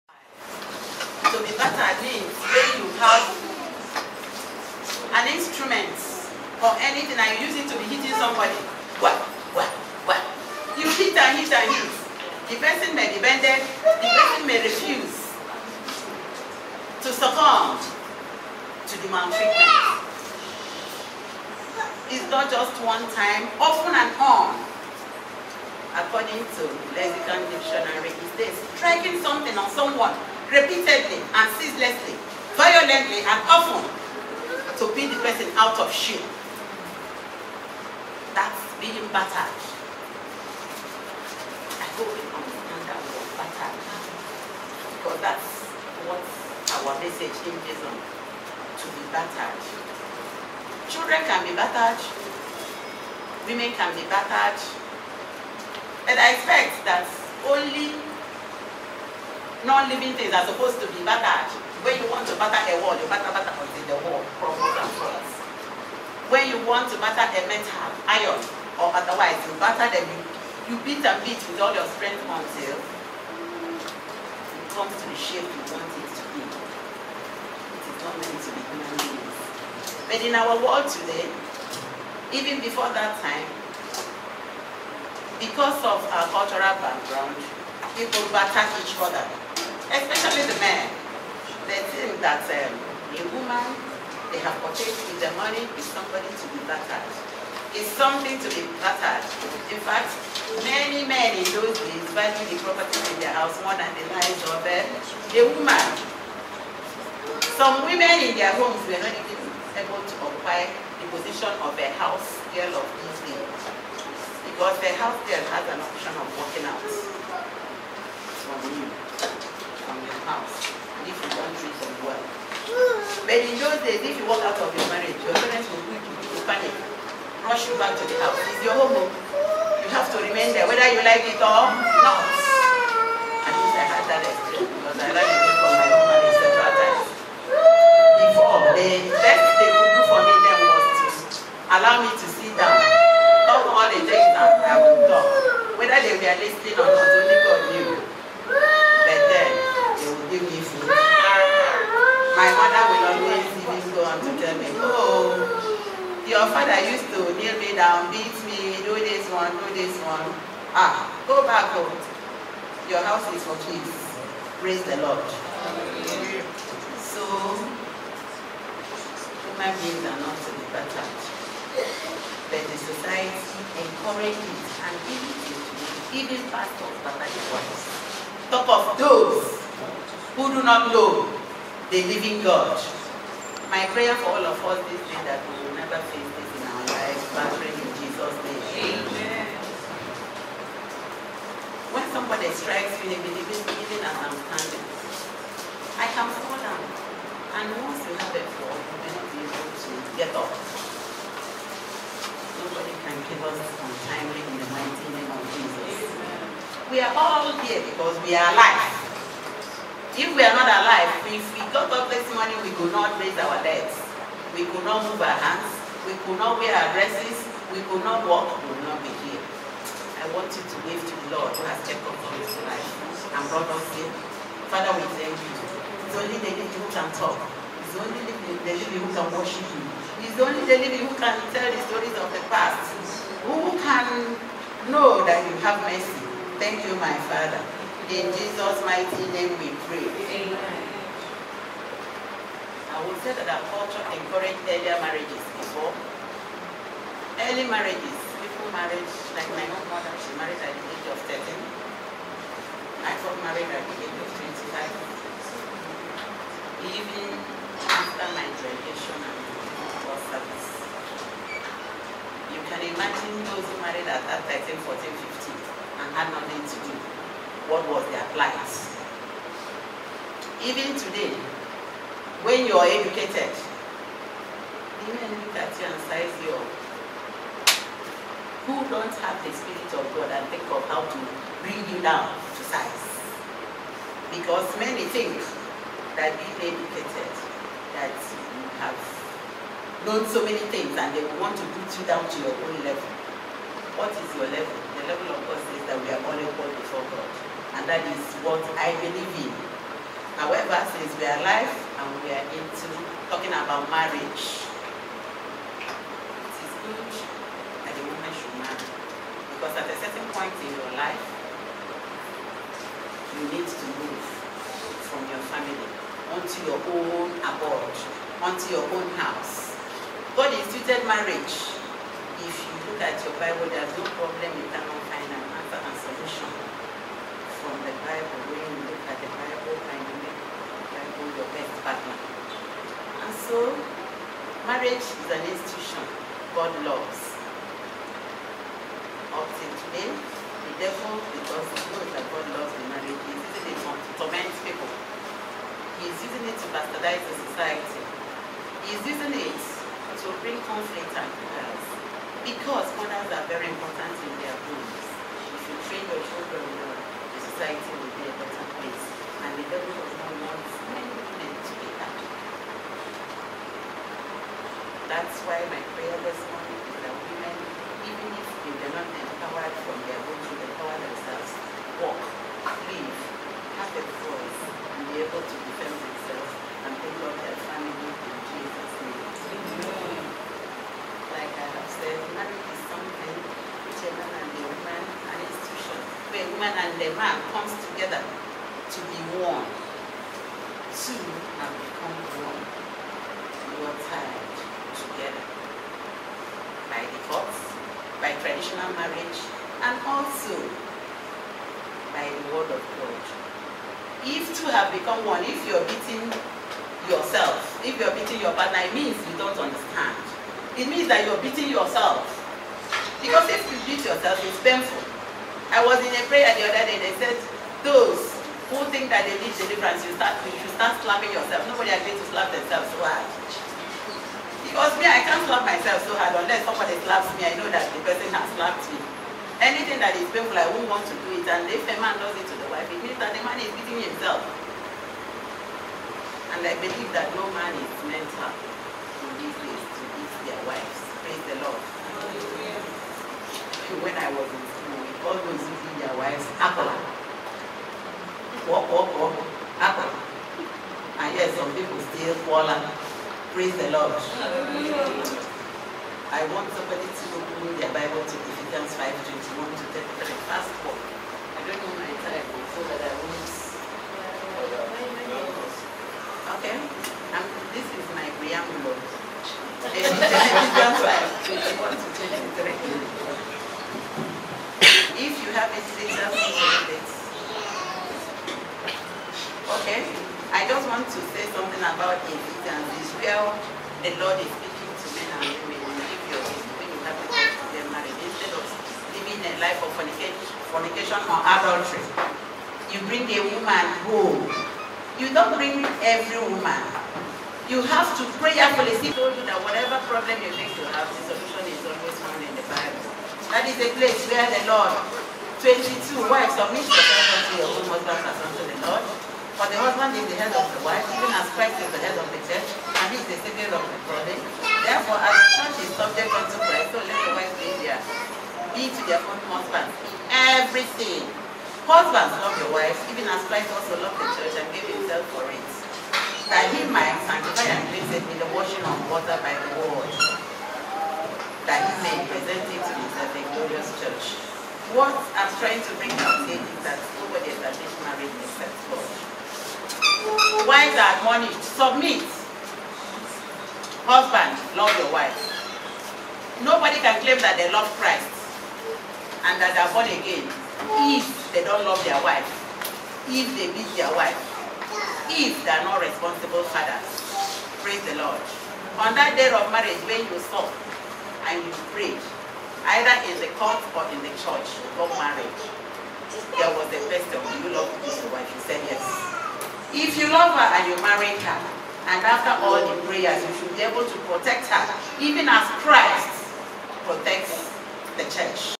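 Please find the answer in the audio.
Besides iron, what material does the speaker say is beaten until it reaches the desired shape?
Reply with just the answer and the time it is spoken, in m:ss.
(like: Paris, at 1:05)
metal, at 1:07.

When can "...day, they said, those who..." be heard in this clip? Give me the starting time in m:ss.
6:56.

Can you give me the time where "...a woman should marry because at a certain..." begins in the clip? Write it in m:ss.
5:07.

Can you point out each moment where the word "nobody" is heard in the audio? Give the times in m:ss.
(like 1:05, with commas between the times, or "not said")
3:22, 7:01, 8:57, 9:06.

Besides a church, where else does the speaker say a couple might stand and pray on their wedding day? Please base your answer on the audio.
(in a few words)
the court.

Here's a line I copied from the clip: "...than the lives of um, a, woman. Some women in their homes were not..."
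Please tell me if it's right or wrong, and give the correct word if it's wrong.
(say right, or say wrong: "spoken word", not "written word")
right.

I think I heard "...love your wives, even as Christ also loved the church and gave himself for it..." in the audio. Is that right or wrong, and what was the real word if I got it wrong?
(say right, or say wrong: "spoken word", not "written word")
right.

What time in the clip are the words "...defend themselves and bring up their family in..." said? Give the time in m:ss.
6:15.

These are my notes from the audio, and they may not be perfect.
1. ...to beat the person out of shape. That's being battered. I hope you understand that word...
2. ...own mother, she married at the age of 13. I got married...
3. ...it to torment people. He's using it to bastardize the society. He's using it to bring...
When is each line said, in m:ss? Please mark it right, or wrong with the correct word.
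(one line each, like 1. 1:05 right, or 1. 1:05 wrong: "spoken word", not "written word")
1. 0:34 right
2. 4:09 right
3. 5:43 right.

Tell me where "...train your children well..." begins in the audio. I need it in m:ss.
5:55.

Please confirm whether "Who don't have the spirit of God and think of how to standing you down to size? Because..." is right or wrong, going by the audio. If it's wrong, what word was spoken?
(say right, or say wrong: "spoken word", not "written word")
wrong: "bring", not "standing".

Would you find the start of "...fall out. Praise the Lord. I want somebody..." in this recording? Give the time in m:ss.
7:32.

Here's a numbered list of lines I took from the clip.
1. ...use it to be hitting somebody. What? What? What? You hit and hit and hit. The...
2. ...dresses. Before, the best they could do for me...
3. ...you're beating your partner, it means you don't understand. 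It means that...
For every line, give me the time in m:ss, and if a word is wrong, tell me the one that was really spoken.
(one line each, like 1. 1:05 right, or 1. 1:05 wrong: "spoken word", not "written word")
1. 0:07 right
2. 2:16 wrong: "times", not "dresses"
3. 6:47 right.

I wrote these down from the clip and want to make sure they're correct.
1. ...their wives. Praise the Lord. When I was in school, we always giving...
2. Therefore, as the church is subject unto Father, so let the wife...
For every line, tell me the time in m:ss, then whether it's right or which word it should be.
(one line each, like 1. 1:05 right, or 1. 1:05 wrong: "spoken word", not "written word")
1. 7:20 right
2. 8:34 wrong: "Christ", not "Father".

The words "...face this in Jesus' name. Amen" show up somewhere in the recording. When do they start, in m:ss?
3:06.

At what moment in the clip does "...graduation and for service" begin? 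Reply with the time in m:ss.
4:18.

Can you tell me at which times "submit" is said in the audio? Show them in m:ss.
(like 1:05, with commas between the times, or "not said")
8:26, 9:01.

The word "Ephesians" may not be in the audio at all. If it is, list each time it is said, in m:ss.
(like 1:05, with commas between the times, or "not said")
7:38, 7:50.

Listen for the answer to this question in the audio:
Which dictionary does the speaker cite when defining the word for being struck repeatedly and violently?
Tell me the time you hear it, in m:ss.
0:26.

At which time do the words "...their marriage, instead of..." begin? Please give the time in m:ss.
8:07.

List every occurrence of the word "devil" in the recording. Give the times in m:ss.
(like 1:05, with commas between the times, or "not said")
5:40, 5:59.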